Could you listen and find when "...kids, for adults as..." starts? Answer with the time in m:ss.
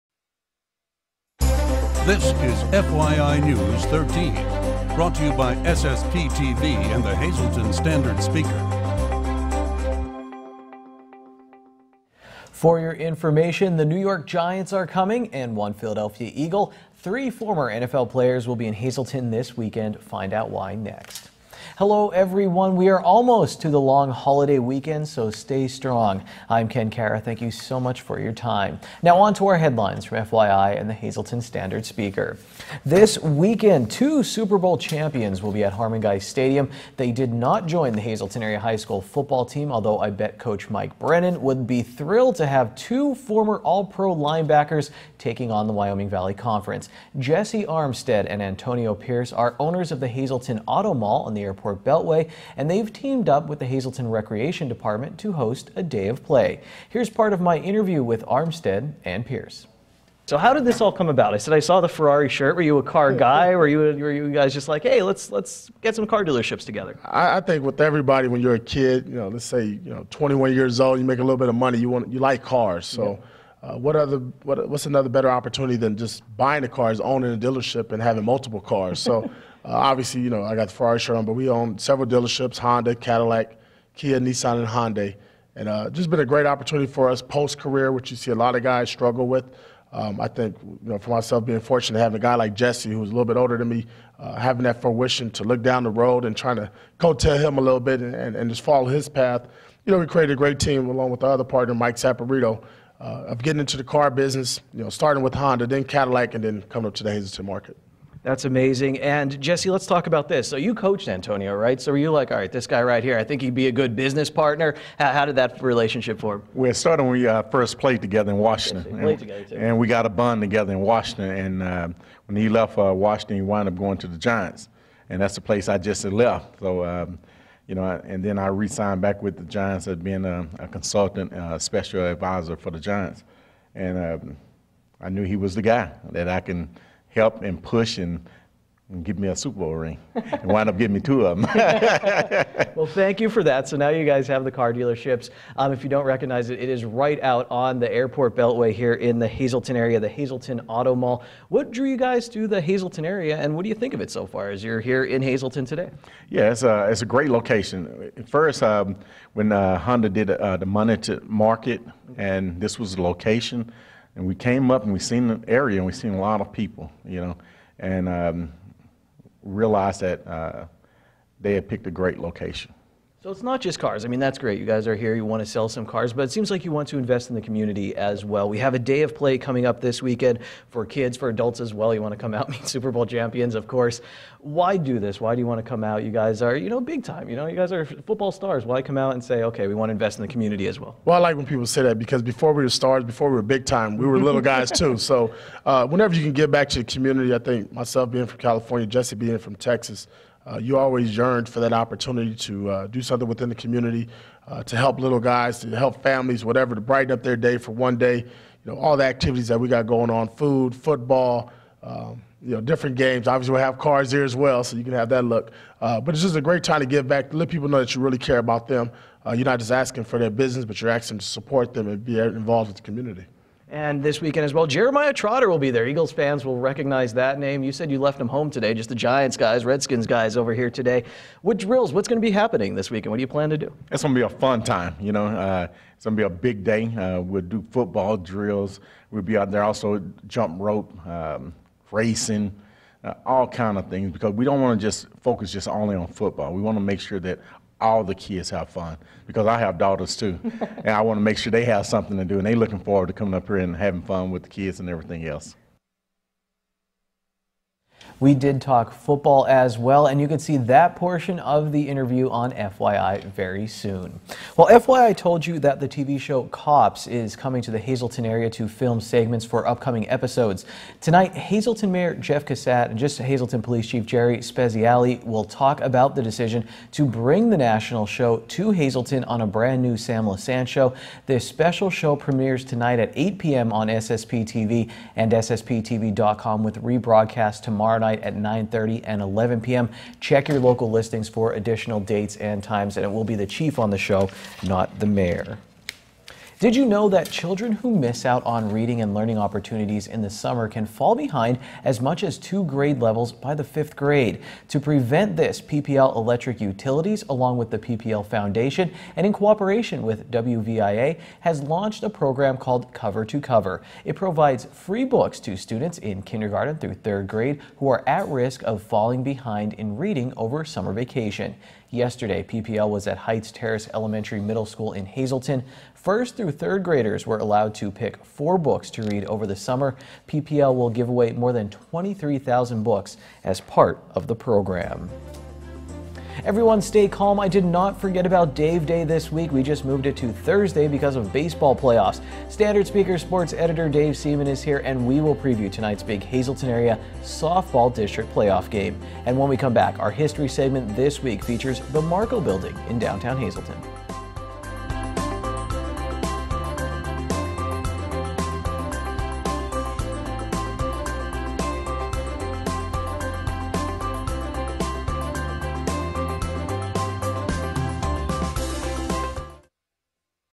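3:00.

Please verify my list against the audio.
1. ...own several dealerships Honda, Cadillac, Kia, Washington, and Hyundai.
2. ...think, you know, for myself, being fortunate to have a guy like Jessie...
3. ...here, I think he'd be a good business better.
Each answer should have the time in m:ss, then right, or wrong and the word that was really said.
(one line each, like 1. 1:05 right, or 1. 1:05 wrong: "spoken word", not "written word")
1. 1:21 wrong: "Nissan", not "Washington"
2. 1:30 right
3. 1:53 wrong: "partner", not "better".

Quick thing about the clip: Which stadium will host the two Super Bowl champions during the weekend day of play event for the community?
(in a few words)
Harman-Geist Stadium.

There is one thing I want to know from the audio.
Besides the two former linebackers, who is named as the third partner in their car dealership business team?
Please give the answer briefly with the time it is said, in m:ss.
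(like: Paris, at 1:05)
Mike Saporito, at 1:41.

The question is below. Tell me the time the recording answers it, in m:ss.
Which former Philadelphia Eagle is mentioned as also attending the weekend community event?
3:44.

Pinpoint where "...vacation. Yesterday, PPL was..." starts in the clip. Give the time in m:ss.
5:20.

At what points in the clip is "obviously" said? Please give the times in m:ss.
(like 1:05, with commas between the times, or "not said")
1:19, 3:33.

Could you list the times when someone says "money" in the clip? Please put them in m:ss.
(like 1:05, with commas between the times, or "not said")
1:11, 2:40.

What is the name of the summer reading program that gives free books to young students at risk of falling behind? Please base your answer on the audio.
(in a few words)
Cover to Cover.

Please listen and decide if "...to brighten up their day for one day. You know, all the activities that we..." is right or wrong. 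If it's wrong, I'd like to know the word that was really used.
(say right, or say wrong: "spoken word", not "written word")
right.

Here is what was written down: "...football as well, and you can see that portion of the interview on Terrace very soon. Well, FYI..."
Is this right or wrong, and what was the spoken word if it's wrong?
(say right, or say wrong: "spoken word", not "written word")
wrong: "FYI", not "Terrace".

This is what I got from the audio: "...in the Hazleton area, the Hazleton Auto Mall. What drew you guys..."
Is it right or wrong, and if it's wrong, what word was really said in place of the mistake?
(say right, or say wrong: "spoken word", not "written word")
right.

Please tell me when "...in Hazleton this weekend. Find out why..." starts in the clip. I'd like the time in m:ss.
0:18.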